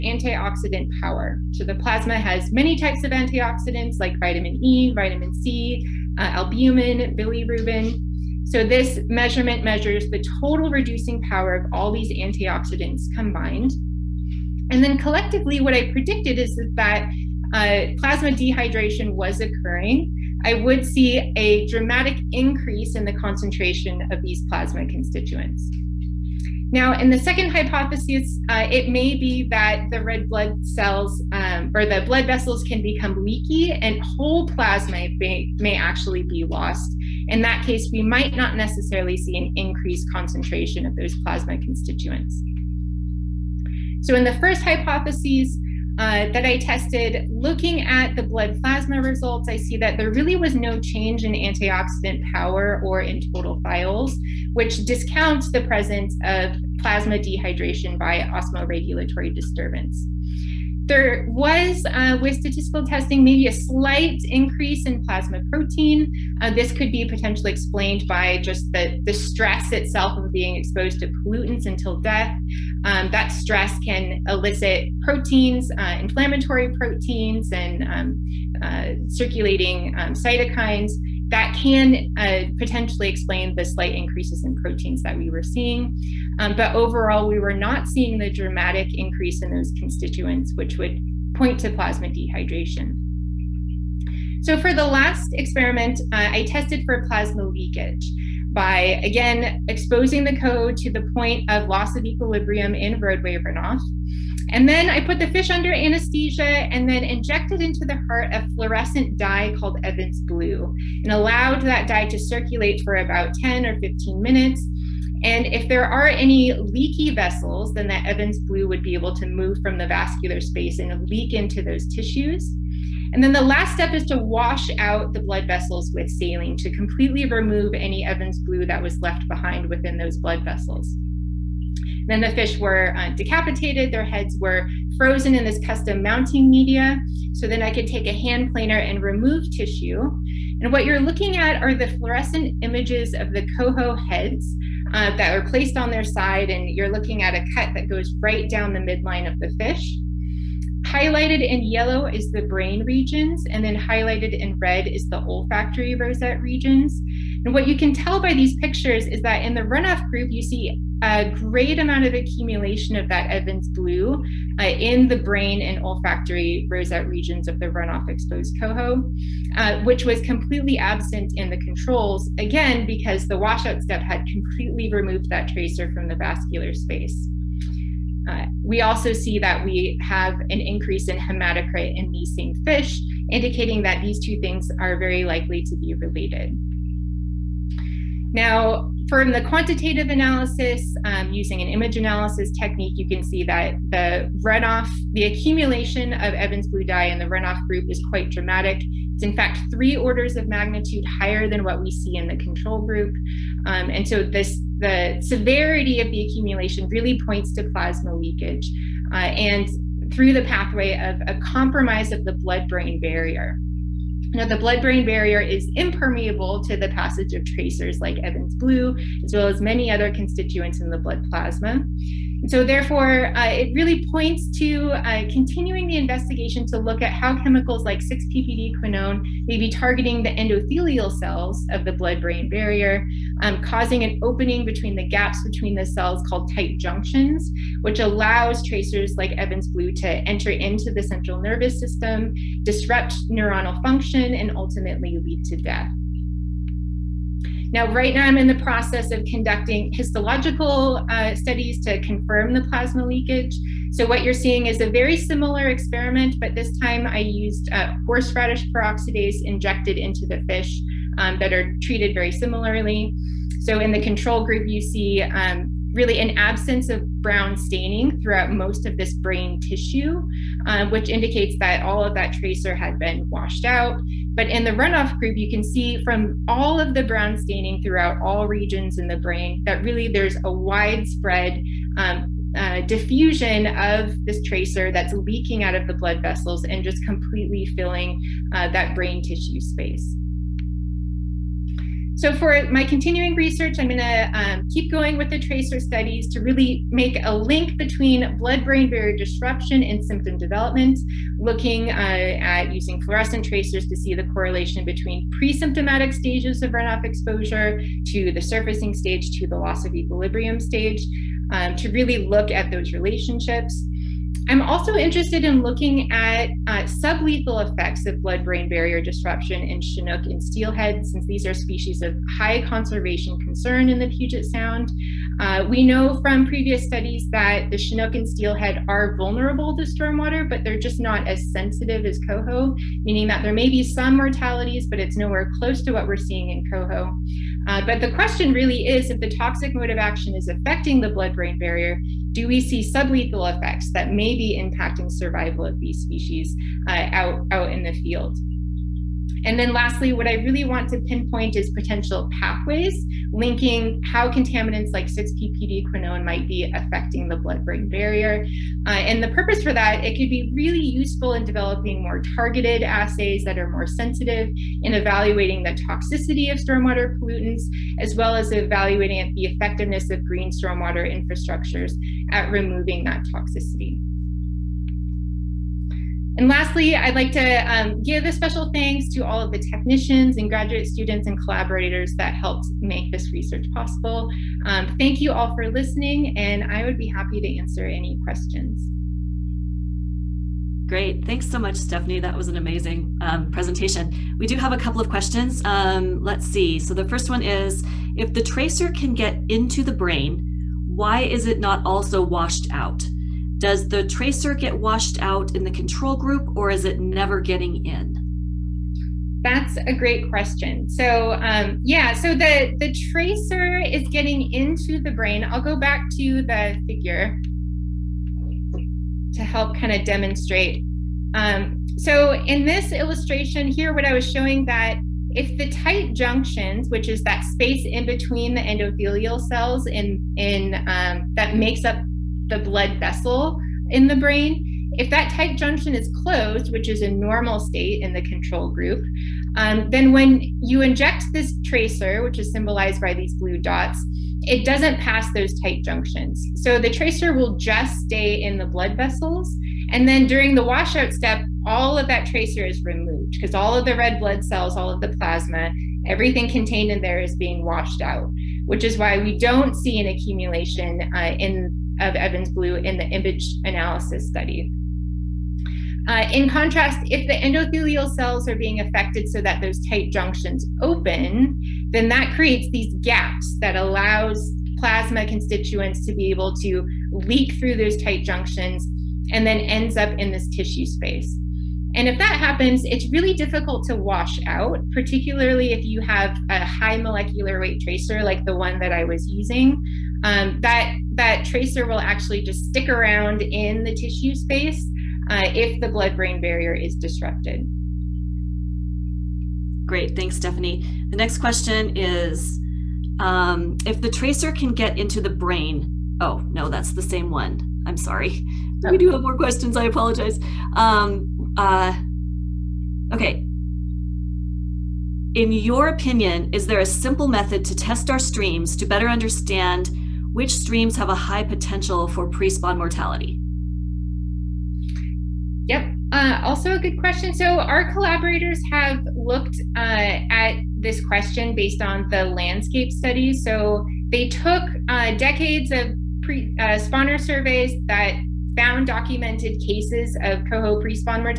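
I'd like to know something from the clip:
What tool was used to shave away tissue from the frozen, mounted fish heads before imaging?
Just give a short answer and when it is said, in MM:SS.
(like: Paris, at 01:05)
hand planer, at 02:18.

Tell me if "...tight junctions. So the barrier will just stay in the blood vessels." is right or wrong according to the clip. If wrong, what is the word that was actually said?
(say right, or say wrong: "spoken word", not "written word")
wrong: "tracer", not "barrier".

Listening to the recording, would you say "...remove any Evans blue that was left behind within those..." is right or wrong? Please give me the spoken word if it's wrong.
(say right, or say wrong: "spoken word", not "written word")
right.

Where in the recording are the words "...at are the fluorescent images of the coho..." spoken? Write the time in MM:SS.
02:21.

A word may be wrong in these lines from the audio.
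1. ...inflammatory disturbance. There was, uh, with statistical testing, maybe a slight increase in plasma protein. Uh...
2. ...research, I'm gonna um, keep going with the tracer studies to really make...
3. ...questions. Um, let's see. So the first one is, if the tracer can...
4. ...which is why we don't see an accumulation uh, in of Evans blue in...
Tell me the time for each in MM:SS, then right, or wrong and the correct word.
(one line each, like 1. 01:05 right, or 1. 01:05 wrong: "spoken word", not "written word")
1. 00:58 wrong: "osmoregulatory", not "inflammatory"
2. 04:53 right
3. 06:35 right
4. 07:38 right.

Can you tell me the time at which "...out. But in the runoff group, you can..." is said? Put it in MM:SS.
04:33.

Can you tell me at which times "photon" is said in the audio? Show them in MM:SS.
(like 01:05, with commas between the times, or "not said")
not said.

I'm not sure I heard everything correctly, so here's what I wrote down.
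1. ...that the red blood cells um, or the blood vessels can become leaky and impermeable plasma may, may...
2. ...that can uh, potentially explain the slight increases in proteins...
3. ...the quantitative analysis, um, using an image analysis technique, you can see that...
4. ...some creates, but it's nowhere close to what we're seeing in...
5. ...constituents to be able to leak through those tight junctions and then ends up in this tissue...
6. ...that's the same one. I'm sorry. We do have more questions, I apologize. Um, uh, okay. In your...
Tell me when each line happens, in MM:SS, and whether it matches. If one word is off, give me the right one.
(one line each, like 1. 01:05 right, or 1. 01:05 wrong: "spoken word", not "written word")
1. 00:29 wrong: "whole", not "impermeable"
2. 01:21 right
3. 03:09 right
4. 05:33 wrong: "mortalities", not "creates"
5. 07:55 right
6. 08:26 right.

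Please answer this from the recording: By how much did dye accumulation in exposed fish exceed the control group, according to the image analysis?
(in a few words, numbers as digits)
three orders of magnitude.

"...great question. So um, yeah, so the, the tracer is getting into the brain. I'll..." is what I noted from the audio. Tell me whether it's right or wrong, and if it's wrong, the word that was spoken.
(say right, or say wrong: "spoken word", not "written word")
right.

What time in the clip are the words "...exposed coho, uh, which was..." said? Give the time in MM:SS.
02:48.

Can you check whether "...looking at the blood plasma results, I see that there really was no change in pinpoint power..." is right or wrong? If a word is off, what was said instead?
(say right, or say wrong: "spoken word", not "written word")
wrong: "antioxidant", not "pinpoint".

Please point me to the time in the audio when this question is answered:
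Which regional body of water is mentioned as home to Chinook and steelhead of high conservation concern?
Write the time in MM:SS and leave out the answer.
05:24.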